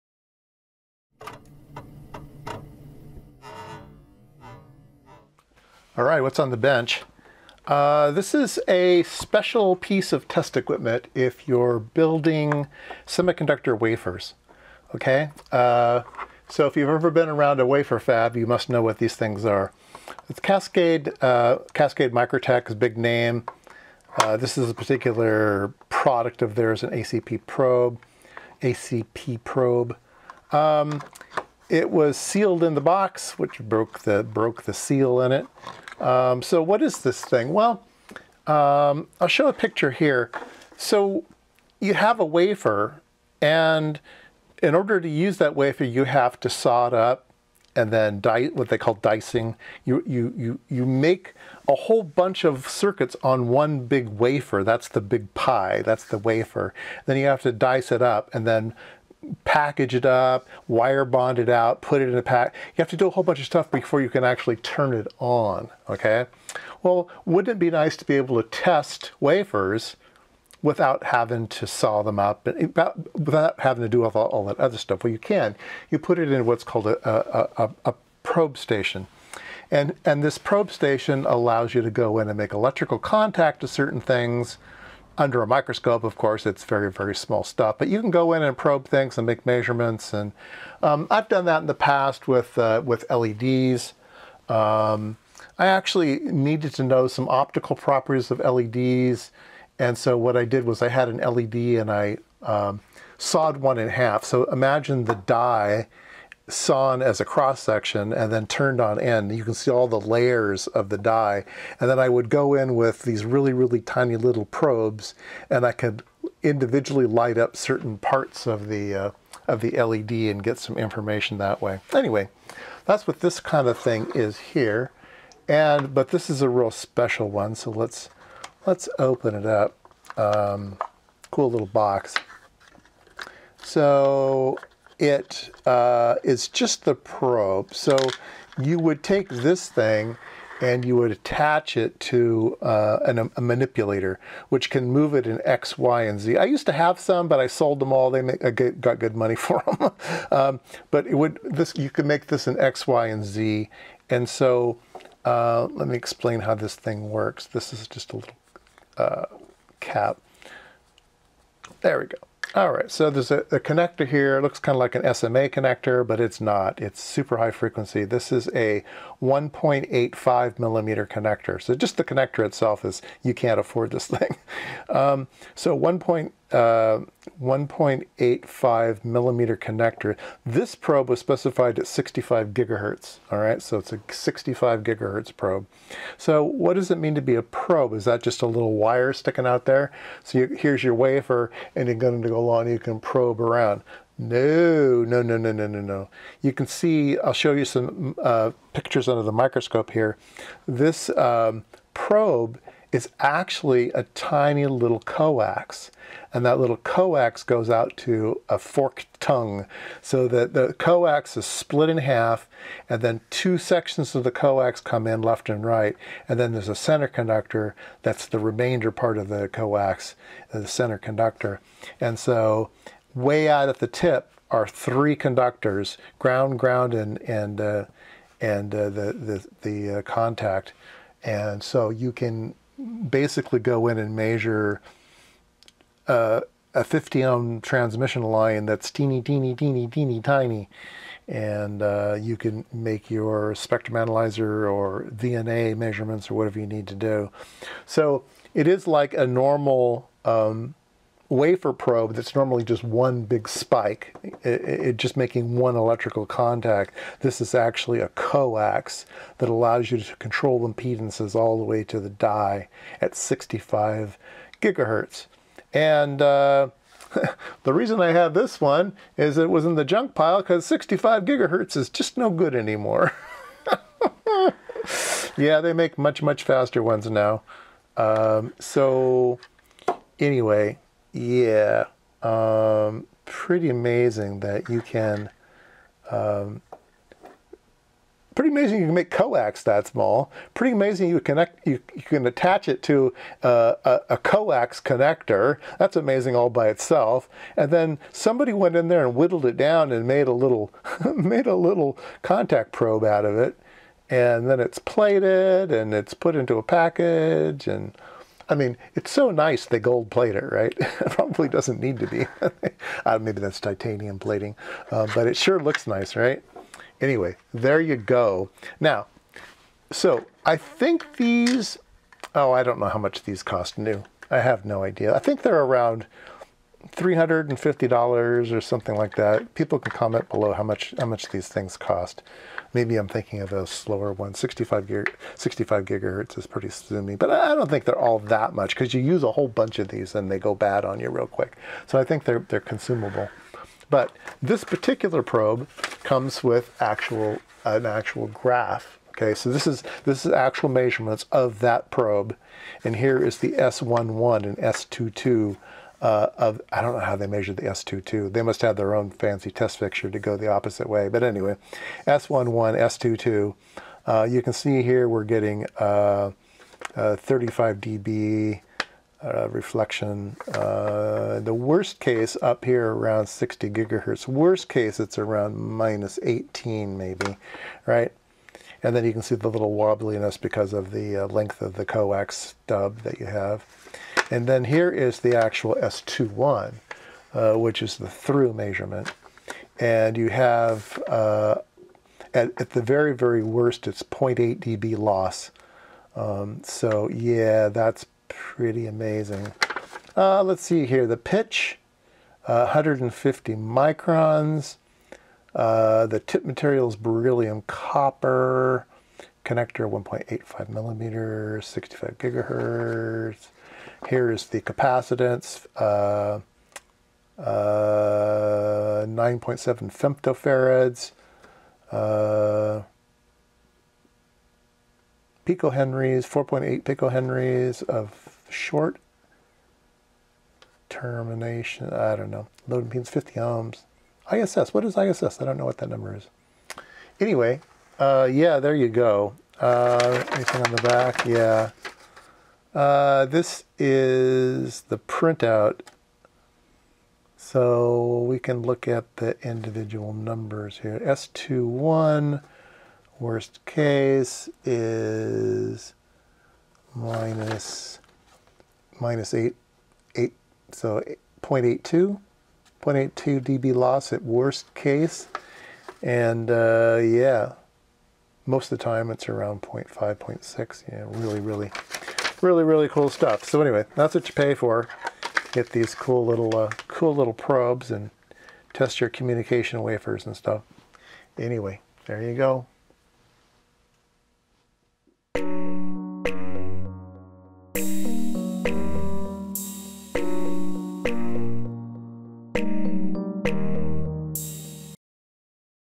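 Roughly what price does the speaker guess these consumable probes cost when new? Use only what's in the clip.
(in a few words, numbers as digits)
$350.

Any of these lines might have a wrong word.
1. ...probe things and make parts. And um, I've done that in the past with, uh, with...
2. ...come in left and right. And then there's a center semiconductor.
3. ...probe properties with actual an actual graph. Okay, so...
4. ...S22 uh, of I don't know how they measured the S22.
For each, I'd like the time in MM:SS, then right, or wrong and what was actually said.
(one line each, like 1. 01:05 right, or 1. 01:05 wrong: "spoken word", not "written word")
1. 01:28 wrong: "measurements", not "parts"
2. 03:34 wrong: "conductor", not "semiconductor"
3. 05:45 wrong: "comes", not "properties"
4. 05:54 right.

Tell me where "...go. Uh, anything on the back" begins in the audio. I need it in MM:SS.
07:18.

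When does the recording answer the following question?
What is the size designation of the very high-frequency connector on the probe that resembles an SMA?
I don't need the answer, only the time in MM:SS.
02:49.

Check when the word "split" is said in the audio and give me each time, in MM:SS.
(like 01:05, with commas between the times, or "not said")
03:31.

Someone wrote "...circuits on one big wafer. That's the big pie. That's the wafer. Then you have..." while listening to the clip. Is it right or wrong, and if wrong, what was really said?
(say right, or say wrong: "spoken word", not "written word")
right.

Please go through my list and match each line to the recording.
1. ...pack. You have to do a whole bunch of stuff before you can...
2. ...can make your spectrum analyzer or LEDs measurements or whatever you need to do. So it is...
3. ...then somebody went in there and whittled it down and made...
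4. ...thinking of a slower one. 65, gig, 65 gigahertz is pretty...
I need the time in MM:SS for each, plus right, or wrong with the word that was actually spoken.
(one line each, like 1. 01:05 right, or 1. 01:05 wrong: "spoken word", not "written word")
1. 01:02 right
2. 04:02 wrong: "VNA", not "LEDs"
3. 04:57 right
4. 05:33 right.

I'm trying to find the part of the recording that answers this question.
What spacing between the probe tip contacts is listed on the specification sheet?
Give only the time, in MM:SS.
06:42.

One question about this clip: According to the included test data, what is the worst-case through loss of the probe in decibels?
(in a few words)
0.8 dB.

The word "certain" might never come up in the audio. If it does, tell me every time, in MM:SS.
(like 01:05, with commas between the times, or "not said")
01:23, 01:57.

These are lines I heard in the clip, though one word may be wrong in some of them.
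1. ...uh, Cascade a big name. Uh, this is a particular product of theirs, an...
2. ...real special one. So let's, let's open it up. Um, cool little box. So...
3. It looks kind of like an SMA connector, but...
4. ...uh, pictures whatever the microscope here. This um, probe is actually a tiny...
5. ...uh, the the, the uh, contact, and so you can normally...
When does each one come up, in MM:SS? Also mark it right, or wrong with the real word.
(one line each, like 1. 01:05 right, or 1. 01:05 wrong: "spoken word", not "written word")
1. 00:21 right
2. 02:06 right
3. 02:44 right
4. 03:18 wrong: "under", not "whatever"
5. 03:48 wrong: "basically", not "normally".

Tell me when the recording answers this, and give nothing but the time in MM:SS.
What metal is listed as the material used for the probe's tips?
06:46.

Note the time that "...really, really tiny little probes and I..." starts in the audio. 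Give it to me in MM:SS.
01:53.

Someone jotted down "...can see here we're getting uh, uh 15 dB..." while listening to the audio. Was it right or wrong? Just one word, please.
wrong.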